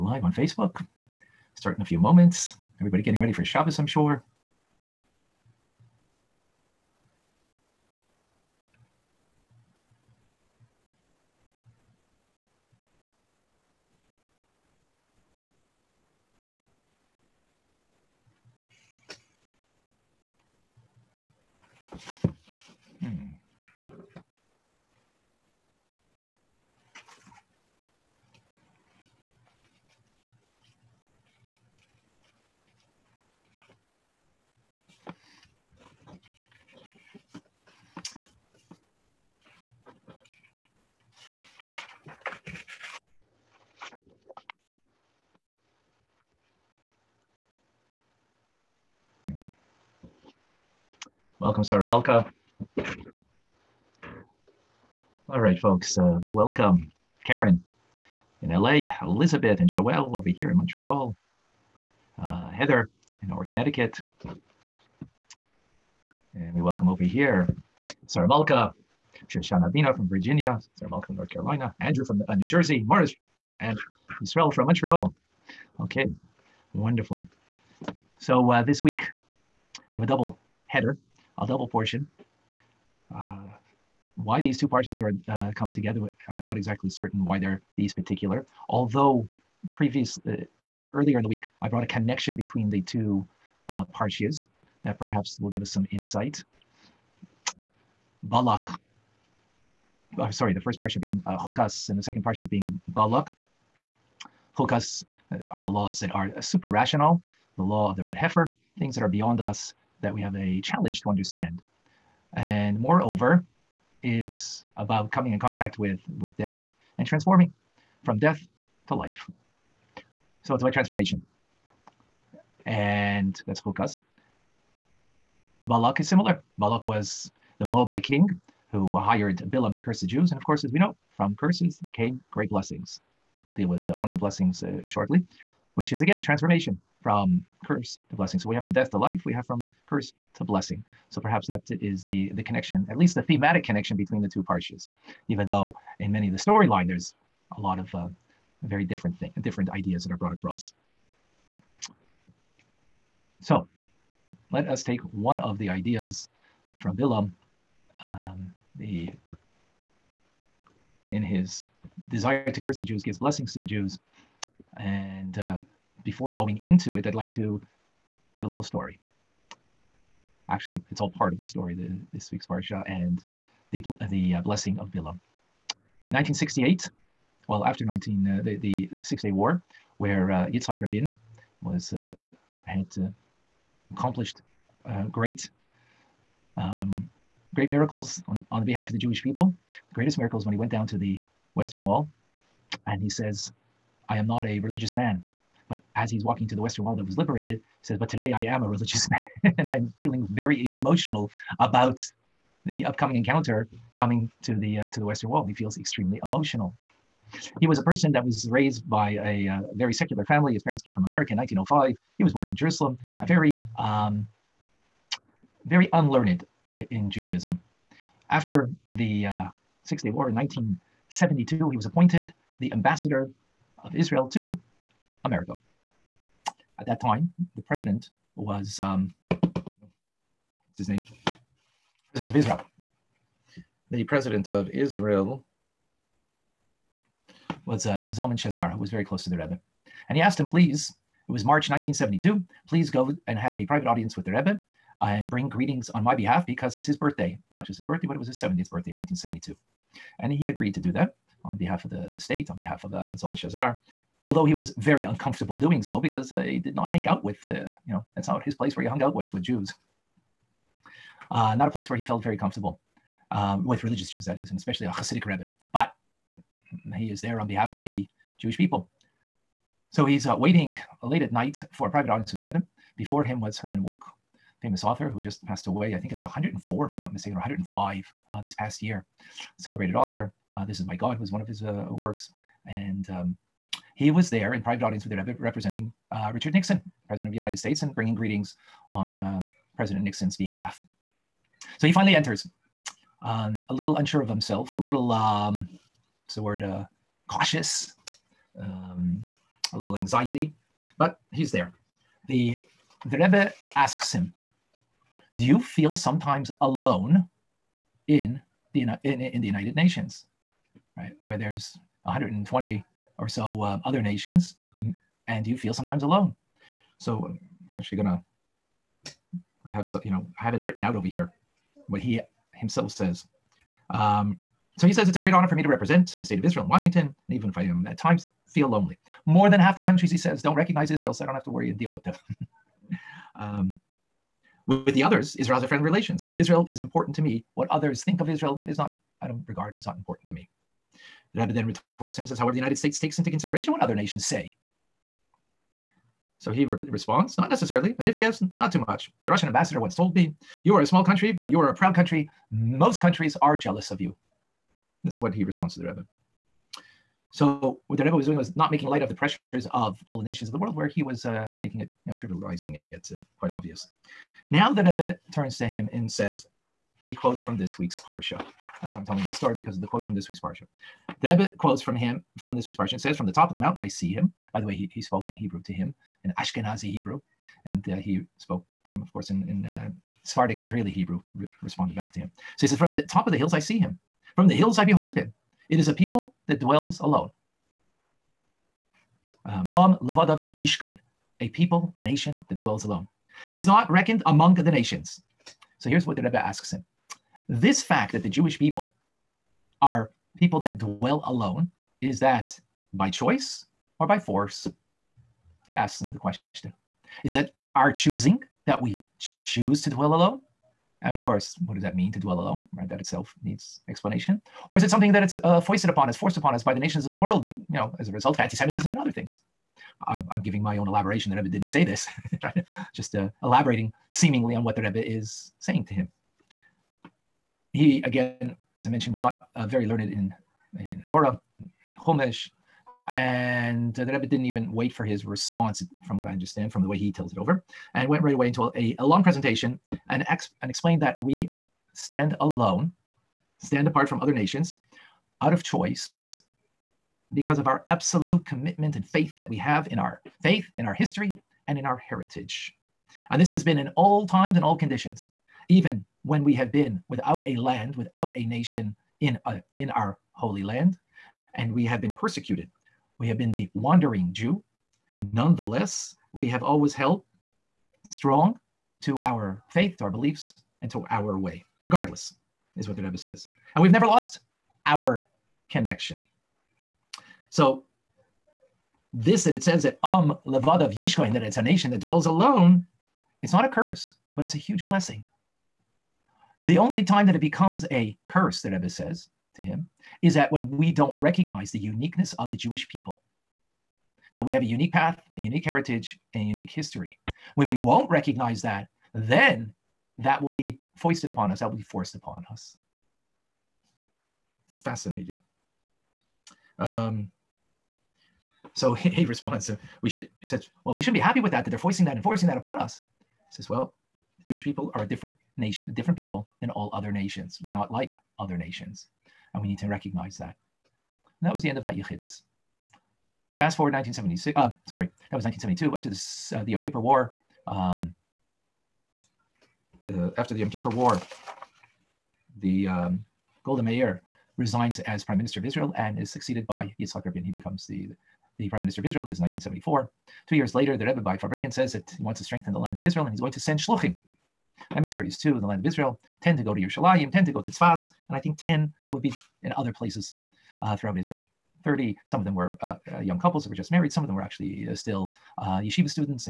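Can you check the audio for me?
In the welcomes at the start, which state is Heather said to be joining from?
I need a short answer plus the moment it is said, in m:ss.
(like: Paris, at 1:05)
Connecticut, at 1:03.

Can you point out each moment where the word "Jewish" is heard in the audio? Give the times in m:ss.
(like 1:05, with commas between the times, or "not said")
3:08, 4:28, 6:38, 8:12, 8:34.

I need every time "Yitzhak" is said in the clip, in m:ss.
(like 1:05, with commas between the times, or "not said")
3:00, 8:56.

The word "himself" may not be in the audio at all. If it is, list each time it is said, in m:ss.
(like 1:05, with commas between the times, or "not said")
4:54, 5:22.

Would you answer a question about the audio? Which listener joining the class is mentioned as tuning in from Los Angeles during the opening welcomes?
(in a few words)
Karen.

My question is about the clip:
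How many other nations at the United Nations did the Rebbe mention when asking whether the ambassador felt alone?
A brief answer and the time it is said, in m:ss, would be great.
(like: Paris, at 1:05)
120, at 5:12.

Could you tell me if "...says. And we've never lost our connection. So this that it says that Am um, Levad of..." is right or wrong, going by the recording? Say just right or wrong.
right.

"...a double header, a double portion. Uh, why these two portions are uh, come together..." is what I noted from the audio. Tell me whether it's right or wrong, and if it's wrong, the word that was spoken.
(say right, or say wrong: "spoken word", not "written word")
right.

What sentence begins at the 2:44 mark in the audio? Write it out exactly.
And uh, before going into it, I'd like to give a little story.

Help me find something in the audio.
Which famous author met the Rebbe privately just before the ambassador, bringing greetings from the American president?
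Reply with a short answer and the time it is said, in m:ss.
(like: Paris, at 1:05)
Herman Wouk, at 4:33.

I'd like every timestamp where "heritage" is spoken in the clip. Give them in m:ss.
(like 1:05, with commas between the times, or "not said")
7:31, 8:15.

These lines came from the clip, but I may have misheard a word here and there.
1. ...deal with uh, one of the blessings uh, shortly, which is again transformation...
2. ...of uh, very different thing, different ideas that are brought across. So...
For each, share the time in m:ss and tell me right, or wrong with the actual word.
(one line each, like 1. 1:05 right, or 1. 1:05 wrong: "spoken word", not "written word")
1. 2:13 right
2. 2:27 right.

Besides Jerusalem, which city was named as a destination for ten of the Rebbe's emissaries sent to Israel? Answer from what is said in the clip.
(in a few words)
Tzfas.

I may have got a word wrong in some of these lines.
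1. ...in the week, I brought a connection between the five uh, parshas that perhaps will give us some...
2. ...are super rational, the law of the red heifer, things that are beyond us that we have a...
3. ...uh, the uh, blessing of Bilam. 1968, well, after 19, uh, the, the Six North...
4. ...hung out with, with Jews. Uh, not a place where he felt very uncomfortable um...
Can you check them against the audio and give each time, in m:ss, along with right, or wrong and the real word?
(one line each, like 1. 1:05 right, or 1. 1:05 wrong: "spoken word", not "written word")
1. 1:31 wrong: "two", not "five"
2. 1:46 right
3. 2:53 wrong: "Day", not "North"
4. 4:18 wrong: "comfortable", not "uncomfortable".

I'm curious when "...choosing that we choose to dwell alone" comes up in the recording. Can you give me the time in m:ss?
6:47.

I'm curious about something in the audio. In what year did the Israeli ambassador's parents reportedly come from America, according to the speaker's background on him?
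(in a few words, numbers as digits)
1905.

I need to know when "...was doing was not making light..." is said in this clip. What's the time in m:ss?
5:58.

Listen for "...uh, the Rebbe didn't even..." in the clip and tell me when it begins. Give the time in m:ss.
7:13.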